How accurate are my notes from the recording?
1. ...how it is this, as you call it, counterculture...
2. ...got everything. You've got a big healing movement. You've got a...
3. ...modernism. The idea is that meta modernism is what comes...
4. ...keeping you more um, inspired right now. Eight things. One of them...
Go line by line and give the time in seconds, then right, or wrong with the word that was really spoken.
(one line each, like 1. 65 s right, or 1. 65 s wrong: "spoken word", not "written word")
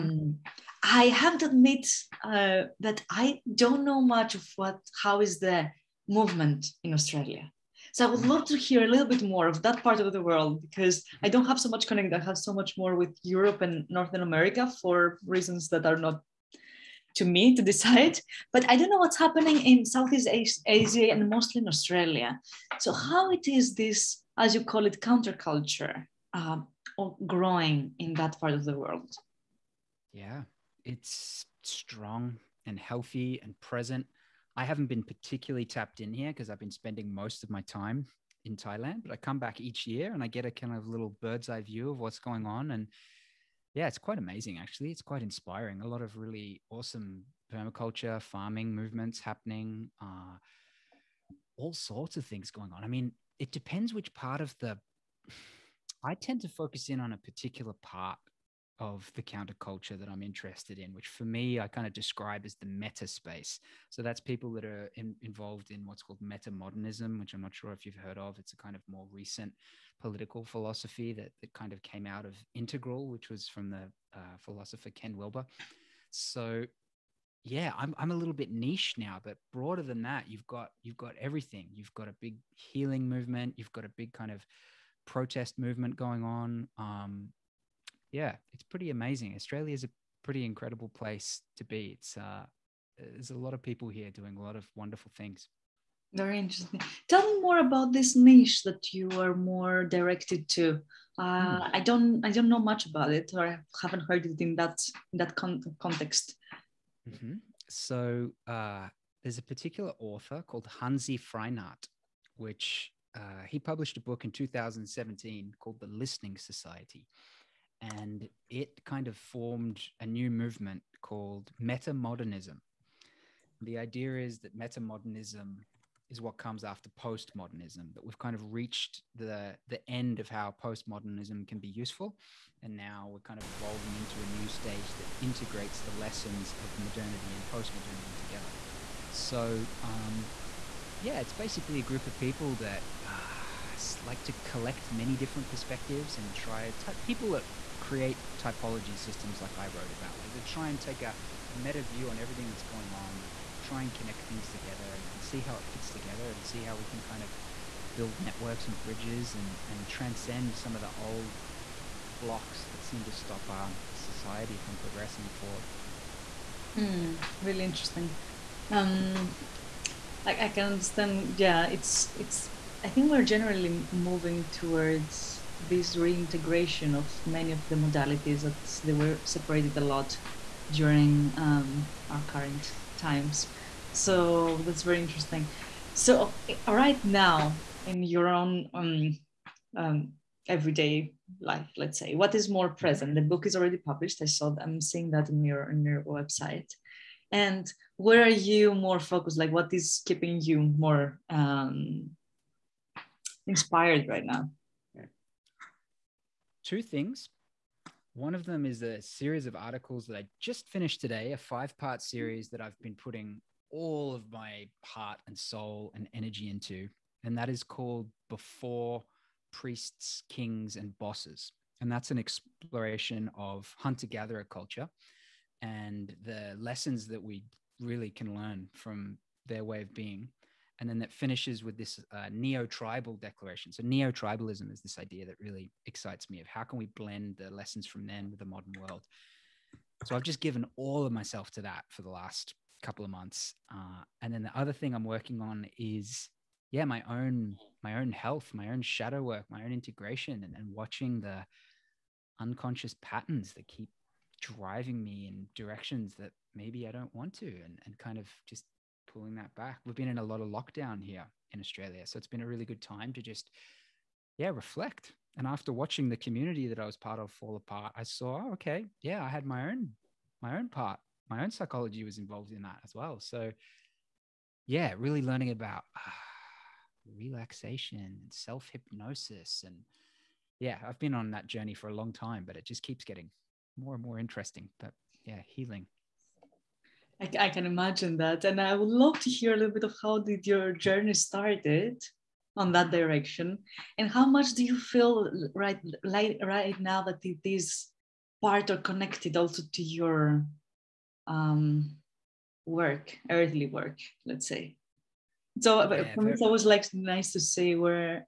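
1. 22 s right
2. 80 s right
3. 121 s right
4. 200 s wrong: "Two", not "Eight".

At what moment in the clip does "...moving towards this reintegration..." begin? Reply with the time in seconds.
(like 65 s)
173 s.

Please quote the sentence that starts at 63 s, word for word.
So that's people that are in, involved in what's called meta modernism, which I'm not sure if you've heard of.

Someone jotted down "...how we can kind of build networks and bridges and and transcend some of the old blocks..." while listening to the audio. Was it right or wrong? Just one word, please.
right.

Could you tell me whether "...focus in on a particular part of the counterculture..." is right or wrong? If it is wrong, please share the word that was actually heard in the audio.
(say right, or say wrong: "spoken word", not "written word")
right.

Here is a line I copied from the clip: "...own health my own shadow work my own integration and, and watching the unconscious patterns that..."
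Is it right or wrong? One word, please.
right.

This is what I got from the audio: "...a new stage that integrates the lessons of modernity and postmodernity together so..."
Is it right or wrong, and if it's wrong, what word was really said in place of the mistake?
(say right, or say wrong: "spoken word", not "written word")
right.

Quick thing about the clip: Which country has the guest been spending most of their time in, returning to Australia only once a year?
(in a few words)
Thailand.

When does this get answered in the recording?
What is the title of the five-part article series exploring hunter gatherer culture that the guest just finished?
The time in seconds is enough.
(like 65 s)
218 s.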